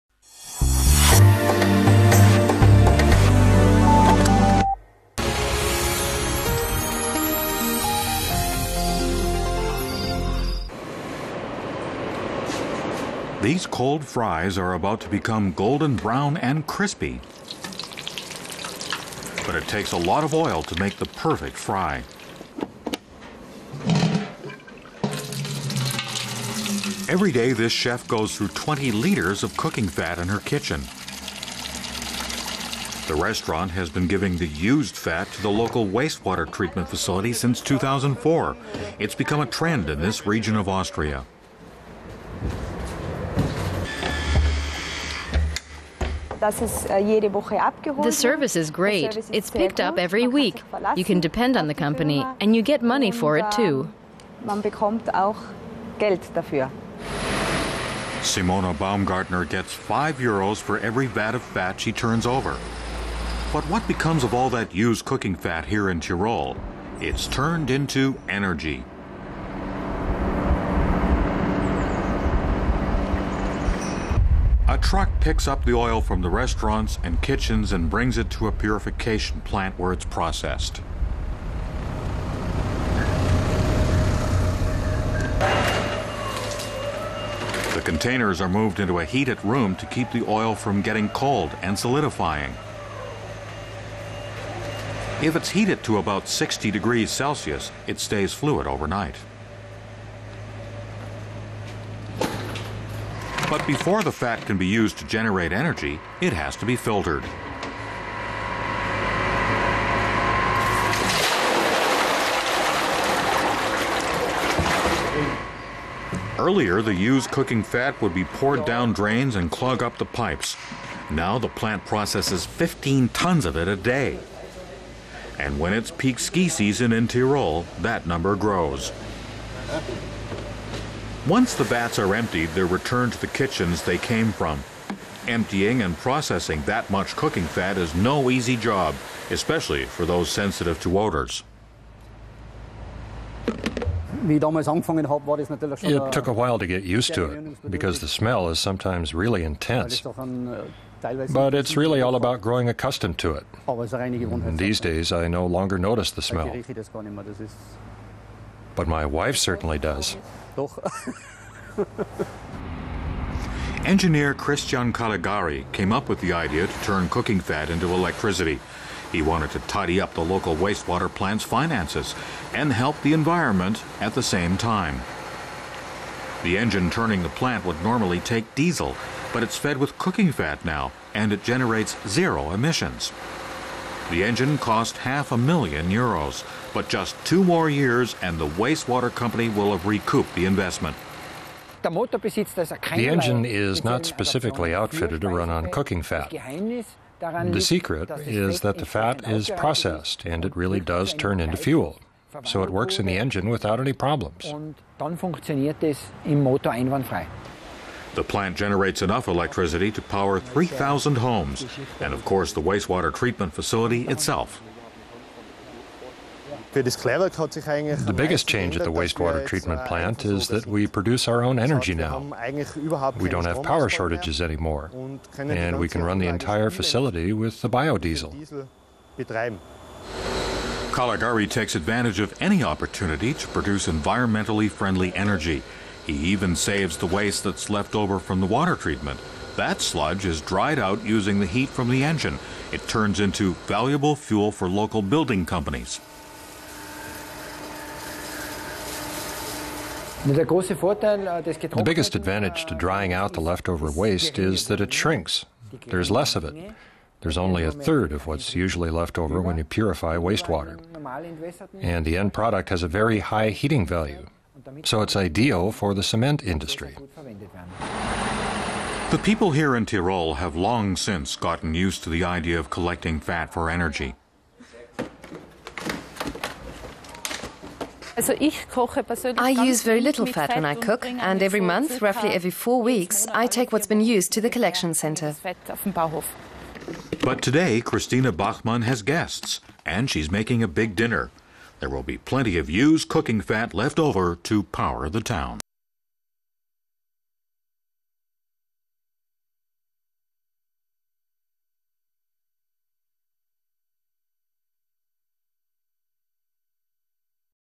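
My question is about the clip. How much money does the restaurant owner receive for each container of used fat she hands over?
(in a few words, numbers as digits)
5 euros.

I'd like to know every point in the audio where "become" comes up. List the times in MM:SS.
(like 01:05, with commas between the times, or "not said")
00:15, 00:39, 01:03.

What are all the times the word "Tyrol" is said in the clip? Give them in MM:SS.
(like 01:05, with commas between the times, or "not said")
01:05, 02:07, 04:29.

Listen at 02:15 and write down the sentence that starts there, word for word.
Emptying and processing that much cooking fat is no easy job, especially for those sensitive to odors.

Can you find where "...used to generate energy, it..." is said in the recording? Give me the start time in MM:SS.
01:44.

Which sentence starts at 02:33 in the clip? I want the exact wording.
And these days, I no longer notice the smell but my wife certainly does.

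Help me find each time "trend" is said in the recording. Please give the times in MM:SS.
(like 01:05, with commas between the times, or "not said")
00:39.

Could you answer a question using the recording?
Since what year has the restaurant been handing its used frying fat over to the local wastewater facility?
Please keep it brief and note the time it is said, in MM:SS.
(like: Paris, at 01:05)
2004, at 00:37.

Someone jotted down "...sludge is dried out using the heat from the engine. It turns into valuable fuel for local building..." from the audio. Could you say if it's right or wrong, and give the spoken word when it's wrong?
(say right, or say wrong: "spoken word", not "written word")
right.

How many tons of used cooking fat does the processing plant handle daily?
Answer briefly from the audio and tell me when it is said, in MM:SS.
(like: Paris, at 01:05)
15 tons, at 02:02.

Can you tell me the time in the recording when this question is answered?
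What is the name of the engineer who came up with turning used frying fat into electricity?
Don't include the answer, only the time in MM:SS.
02:44.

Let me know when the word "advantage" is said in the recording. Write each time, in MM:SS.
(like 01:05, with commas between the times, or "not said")
03:51, 04:12.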